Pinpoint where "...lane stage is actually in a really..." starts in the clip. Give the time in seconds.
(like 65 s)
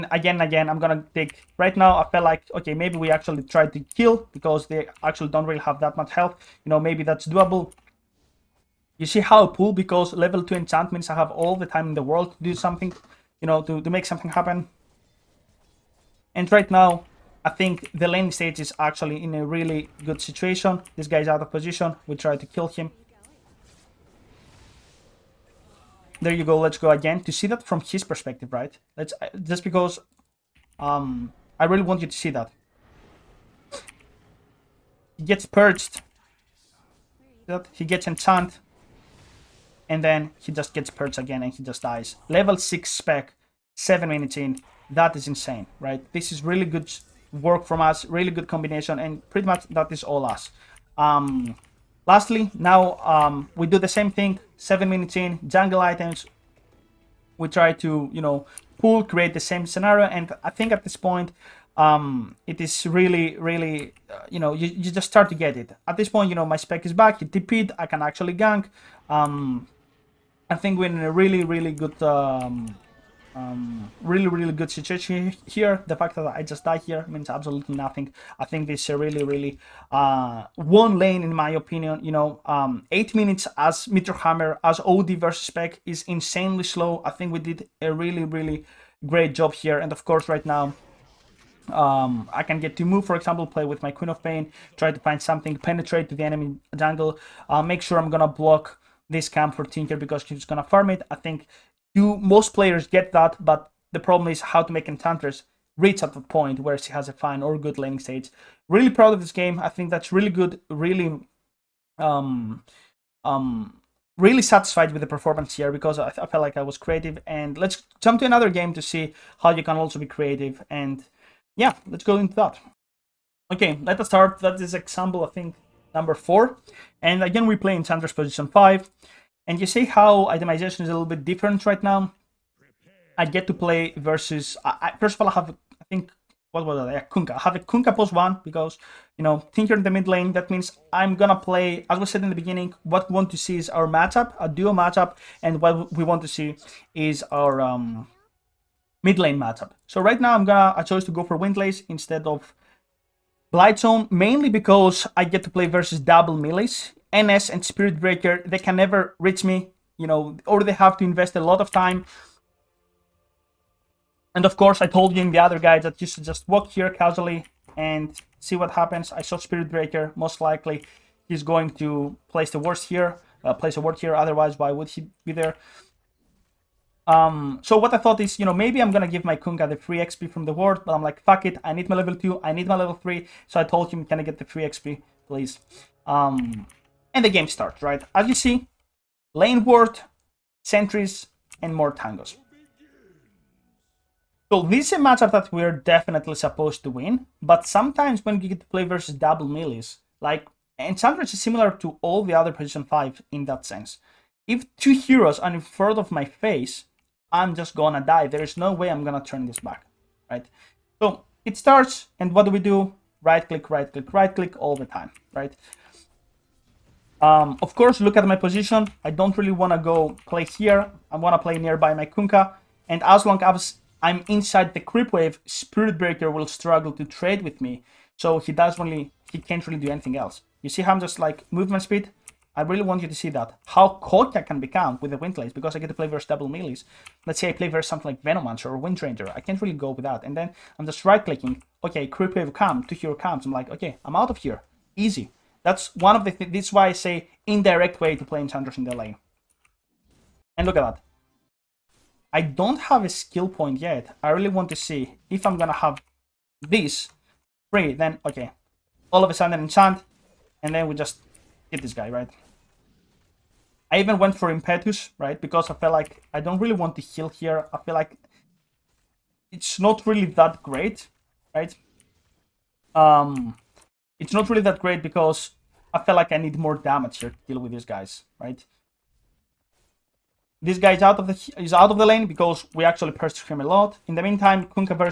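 18 s.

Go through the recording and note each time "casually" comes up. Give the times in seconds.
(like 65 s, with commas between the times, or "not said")
166 s.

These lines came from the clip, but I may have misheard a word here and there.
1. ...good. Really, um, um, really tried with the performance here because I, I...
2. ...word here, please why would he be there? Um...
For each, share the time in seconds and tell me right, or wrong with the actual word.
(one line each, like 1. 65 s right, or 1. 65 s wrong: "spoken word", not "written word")
1. 110 s wrong: "satisfied", not "tried"
2. 173 s wrong: "otherwise", not "please".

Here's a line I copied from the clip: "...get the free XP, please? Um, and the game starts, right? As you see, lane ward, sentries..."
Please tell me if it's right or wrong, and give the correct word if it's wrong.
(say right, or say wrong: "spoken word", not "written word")
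right.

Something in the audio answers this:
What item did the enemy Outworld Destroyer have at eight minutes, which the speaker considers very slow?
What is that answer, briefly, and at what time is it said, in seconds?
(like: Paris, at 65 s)
Meteor Hammer, at 83 s.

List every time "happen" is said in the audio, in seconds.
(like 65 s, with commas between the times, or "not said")
14 s, 168 s.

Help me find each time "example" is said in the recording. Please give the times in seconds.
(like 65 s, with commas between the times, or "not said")
93 s, 124 s.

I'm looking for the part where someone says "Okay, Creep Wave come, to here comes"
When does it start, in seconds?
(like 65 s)
241 s.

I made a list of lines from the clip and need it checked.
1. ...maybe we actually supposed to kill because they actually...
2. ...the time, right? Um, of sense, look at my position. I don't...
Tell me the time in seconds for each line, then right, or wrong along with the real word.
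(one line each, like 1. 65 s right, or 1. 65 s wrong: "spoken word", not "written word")
1. 2 s wrong: "tried", not "supposed"
2. 214 s wrong: "course", not "sense".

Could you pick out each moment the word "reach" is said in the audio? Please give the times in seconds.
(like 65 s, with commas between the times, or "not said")
105 s, 159 s.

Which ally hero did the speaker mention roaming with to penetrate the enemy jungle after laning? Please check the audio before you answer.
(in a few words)
Queen of Pain.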